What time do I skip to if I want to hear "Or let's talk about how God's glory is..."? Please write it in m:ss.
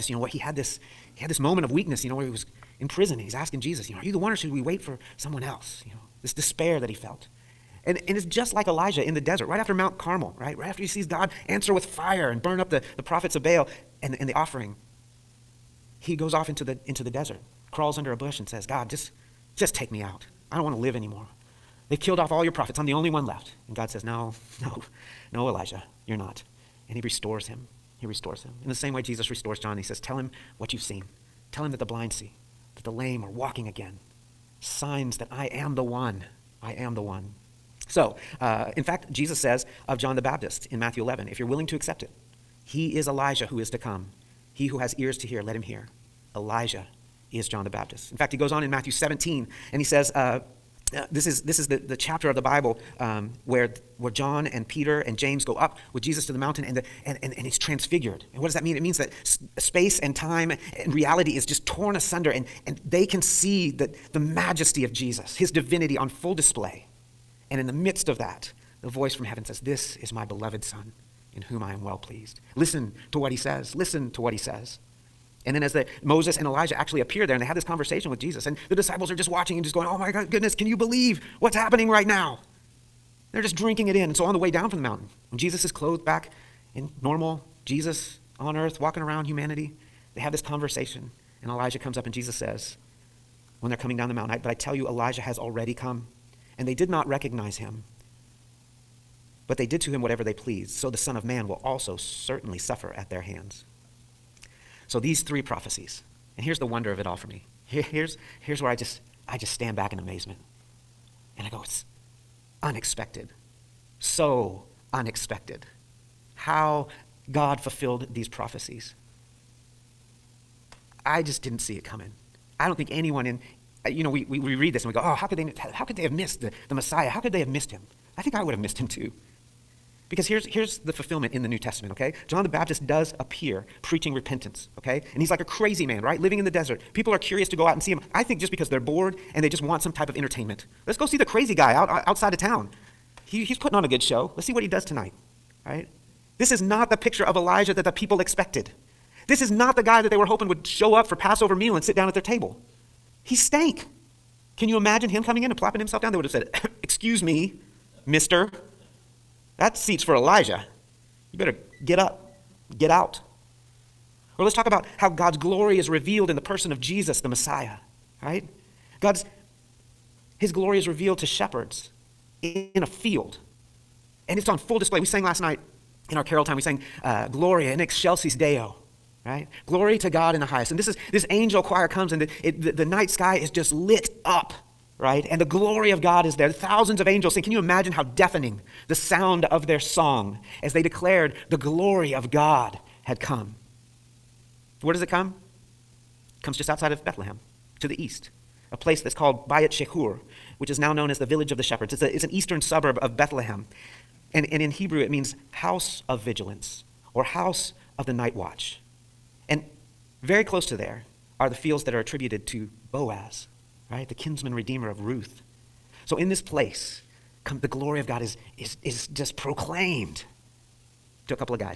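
2:44.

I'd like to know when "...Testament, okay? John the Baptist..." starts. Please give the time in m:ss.
2:11.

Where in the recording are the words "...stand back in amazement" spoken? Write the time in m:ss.
1:49.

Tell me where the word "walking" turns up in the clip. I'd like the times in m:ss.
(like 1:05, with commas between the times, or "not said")
0:33, 1:28.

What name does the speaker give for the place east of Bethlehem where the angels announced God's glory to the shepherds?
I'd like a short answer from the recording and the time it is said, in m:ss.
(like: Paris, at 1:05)
Bayat Shechur, at 3:19.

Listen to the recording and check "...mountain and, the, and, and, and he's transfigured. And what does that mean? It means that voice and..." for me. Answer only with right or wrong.
wrong.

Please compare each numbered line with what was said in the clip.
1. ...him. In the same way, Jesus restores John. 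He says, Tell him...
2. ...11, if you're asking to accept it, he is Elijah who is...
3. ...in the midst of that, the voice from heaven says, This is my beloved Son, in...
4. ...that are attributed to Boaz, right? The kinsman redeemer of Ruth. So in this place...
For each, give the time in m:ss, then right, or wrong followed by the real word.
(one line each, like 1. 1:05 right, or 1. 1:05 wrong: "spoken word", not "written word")
1. 0:28 right
2. 0:41 wrong: "willing", not "asking"
3. 1:07 right
4. 3:31 right.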